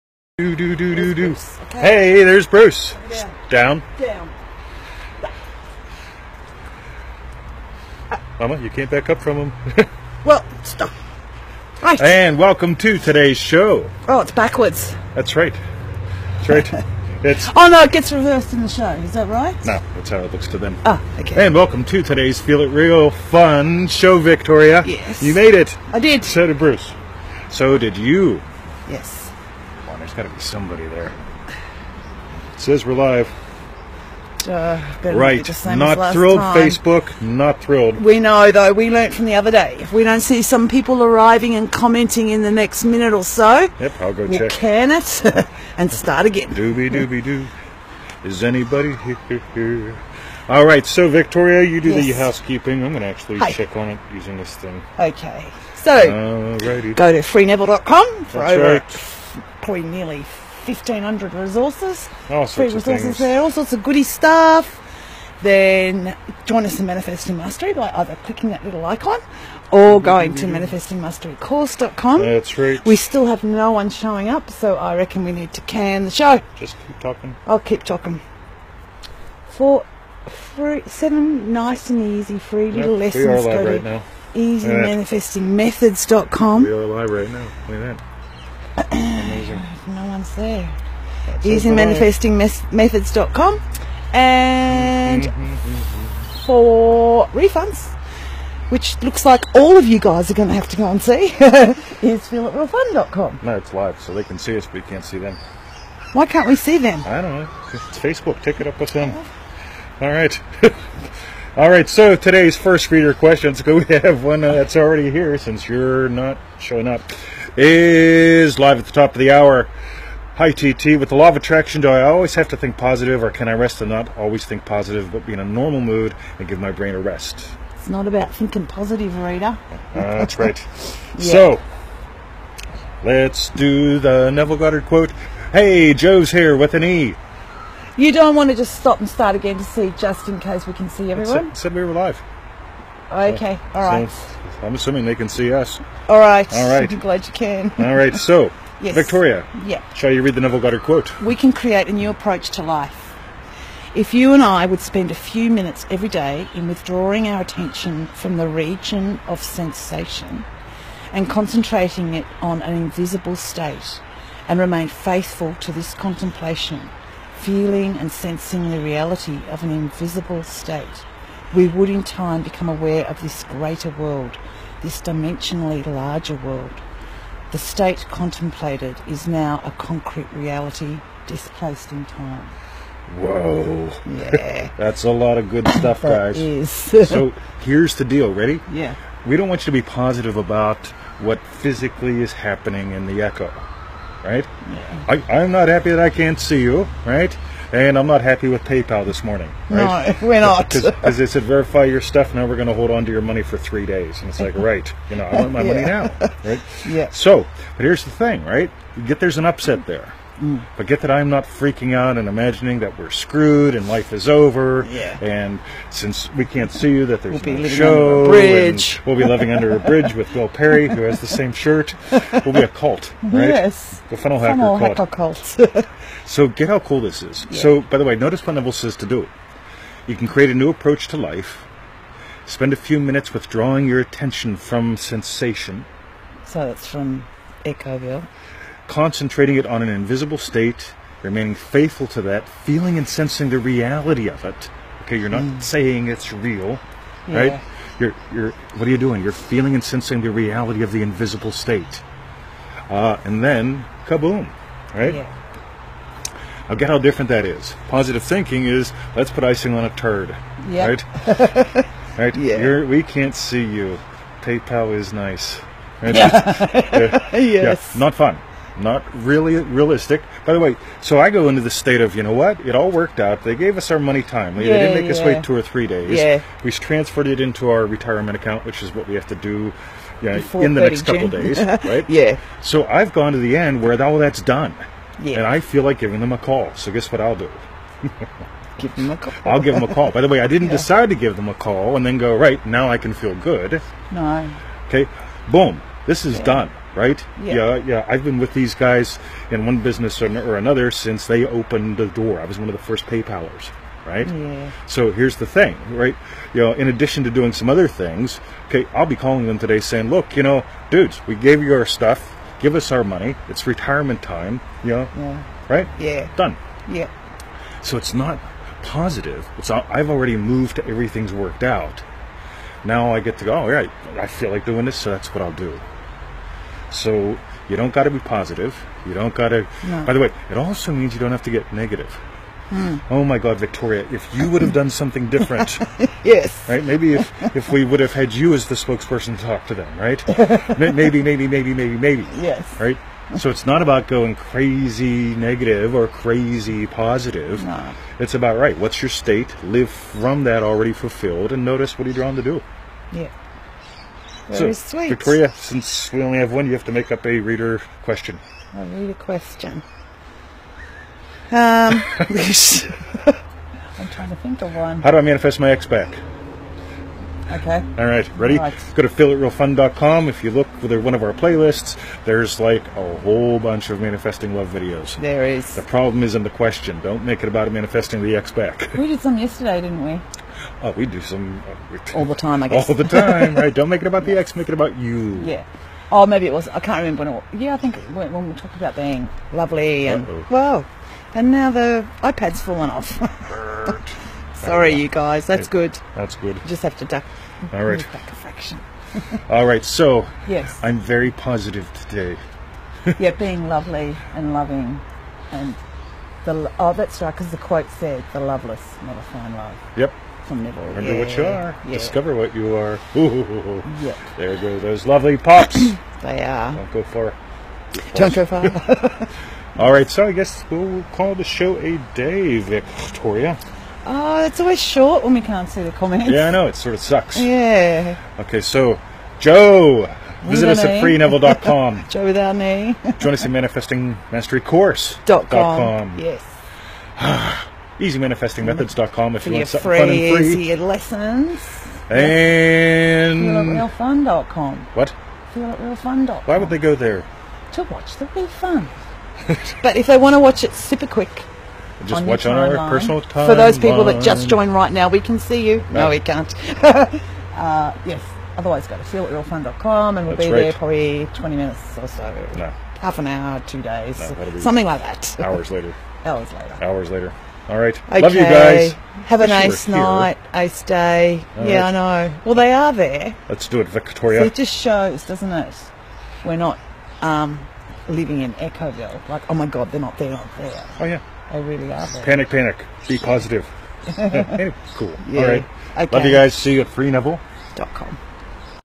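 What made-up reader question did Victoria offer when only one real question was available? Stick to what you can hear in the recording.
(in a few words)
manifest my ex back.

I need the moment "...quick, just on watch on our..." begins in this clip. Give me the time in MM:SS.
07:31.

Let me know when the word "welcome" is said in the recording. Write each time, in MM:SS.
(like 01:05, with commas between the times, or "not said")
00:12, 00:21.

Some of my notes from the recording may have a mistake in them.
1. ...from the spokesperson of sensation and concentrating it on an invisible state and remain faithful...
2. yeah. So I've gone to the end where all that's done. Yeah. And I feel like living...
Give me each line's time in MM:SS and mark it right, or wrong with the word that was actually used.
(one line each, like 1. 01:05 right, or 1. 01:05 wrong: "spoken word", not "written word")
1. 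02:38 wrong: "region", not "spokesperson"
2. 04:42 wrong: "giving", not "living".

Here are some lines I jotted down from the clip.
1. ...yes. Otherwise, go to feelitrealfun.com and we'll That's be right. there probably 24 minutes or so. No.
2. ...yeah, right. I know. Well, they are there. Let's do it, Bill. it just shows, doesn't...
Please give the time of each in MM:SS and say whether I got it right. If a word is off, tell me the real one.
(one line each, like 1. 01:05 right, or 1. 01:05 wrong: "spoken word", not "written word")
1. 07:38 wrong: "20", not "24"
2. 07:51 wrong: "Victoria", not "Bill".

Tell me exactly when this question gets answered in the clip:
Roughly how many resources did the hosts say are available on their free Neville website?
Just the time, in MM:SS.
01:00.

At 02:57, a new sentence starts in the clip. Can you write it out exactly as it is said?
The state contemplated is now a concrete reality displaced in time.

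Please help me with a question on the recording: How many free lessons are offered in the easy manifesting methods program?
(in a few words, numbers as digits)
seven.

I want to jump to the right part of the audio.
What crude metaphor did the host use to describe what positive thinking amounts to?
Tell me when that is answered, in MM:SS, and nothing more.
04:19.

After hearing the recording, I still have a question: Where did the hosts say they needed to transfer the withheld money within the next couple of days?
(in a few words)
retirement account.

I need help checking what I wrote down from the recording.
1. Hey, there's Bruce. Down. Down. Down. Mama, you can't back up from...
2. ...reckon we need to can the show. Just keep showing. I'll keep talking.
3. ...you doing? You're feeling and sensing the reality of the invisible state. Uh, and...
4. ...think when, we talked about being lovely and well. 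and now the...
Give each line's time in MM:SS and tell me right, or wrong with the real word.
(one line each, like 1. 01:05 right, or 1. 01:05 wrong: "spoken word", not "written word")
1. 00:01 right
2. 01:14 wrong: "talking", not "showing"
3. 04:08 right
4. 06:27 right.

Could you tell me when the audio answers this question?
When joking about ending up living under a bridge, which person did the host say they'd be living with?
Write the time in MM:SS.
03:40.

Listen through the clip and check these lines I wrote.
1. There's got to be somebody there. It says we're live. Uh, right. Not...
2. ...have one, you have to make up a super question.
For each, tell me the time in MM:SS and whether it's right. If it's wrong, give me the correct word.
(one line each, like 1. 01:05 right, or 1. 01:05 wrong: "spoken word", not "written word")
1. 00:30 right
2. 05:56 wrong: "reader", not "super".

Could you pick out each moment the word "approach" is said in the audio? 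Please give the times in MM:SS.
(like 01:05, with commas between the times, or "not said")
02:32, 03:50.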